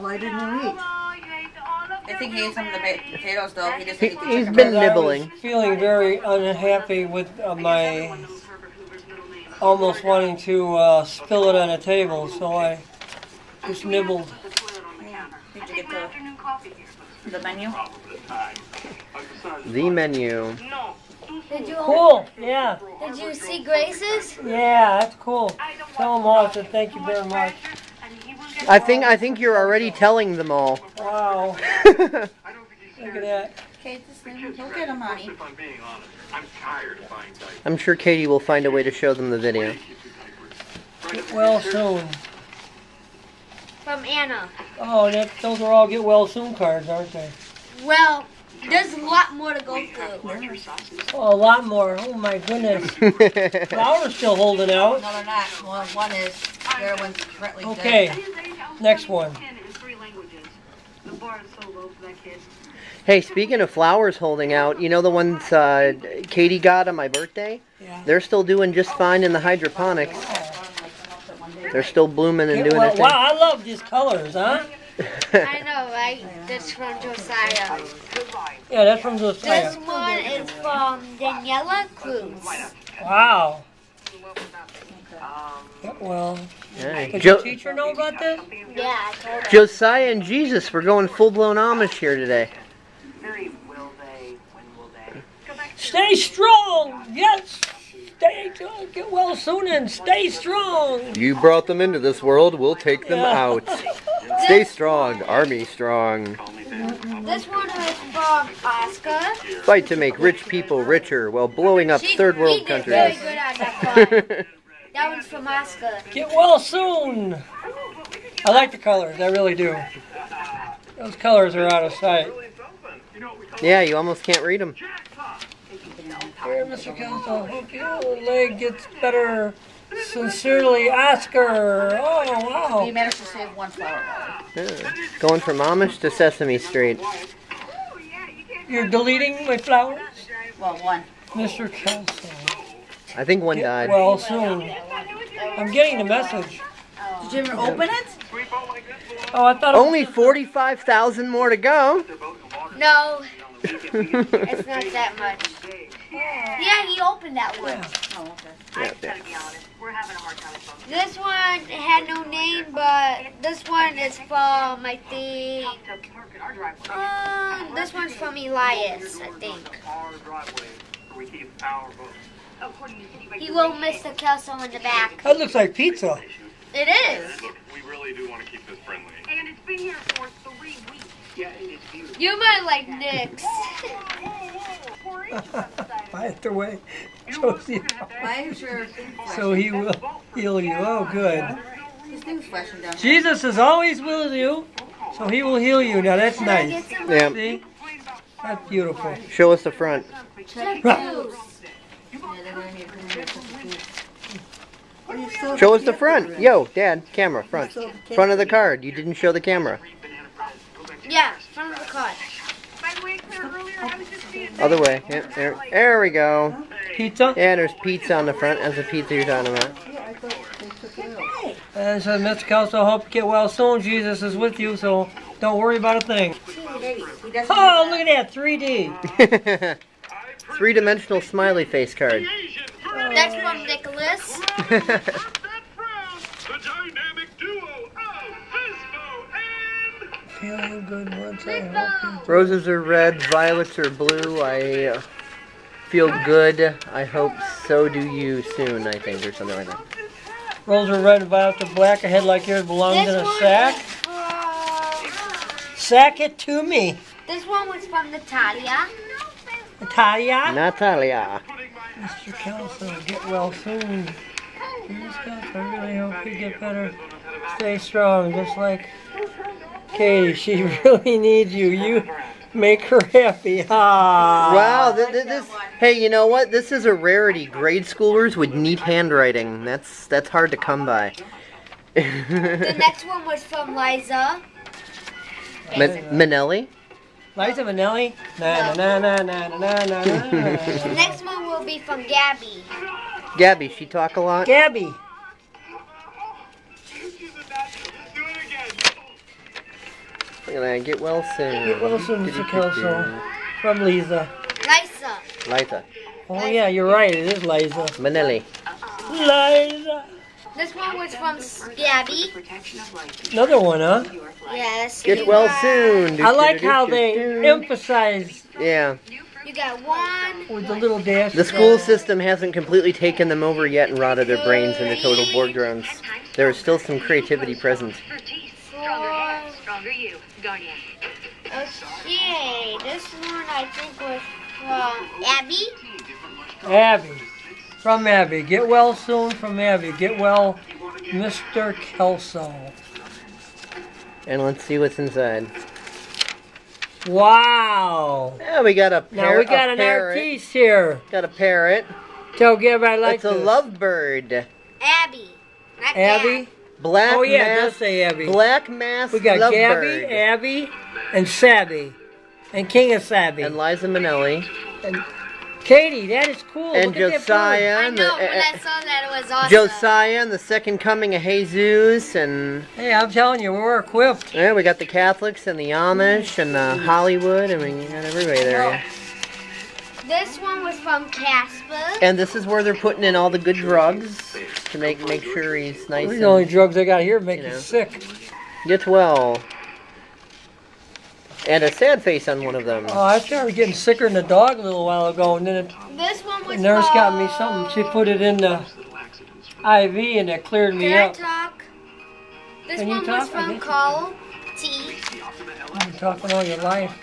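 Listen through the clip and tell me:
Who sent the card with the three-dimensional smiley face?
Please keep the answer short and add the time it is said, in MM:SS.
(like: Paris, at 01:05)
Nicholas, at 03:53.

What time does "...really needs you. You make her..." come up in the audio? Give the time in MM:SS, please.
04:30.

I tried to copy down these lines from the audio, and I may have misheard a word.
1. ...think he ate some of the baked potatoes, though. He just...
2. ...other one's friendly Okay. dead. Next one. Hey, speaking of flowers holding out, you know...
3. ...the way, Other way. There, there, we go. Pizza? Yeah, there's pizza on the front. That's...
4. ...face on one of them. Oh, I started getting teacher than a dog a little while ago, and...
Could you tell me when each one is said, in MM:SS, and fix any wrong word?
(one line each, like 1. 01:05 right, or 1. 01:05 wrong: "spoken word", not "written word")
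1. 00:02 right
2. 00:56 wrong: "currently", not "friendly"
3. 03:32 right
4. 06:32 wrong: "sicker", not "teacher".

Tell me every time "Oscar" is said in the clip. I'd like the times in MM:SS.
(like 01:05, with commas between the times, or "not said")
01:48, 01:55, 02:10.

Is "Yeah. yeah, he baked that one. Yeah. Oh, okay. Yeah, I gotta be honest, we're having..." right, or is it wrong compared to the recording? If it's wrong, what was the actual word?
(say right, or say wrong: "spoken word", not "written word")
wrong: "opened", not "baked".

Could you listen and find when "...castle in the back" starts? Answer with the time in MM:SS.
02:54.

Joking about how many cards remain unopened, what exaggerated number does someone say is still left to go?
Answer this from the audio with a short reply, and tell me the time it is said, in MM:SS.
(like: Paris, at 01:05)
45,000, at 02:30.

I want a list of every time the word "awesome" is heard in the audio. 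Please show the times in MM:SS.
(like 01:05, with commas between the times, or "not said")
06:09.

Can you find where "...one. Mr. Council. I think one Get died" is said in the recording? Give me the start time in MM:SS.
02:20.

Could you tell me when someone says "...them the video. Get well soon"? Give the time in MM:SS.
00:39.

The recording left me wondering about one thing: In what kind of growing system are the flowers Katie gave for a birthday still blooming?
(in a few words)
hydroponics.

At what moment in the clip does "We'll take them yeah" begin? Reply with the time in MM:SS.
01:42.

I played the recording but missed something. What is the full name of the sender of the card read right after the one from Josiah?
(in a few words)
Daniela Cruz.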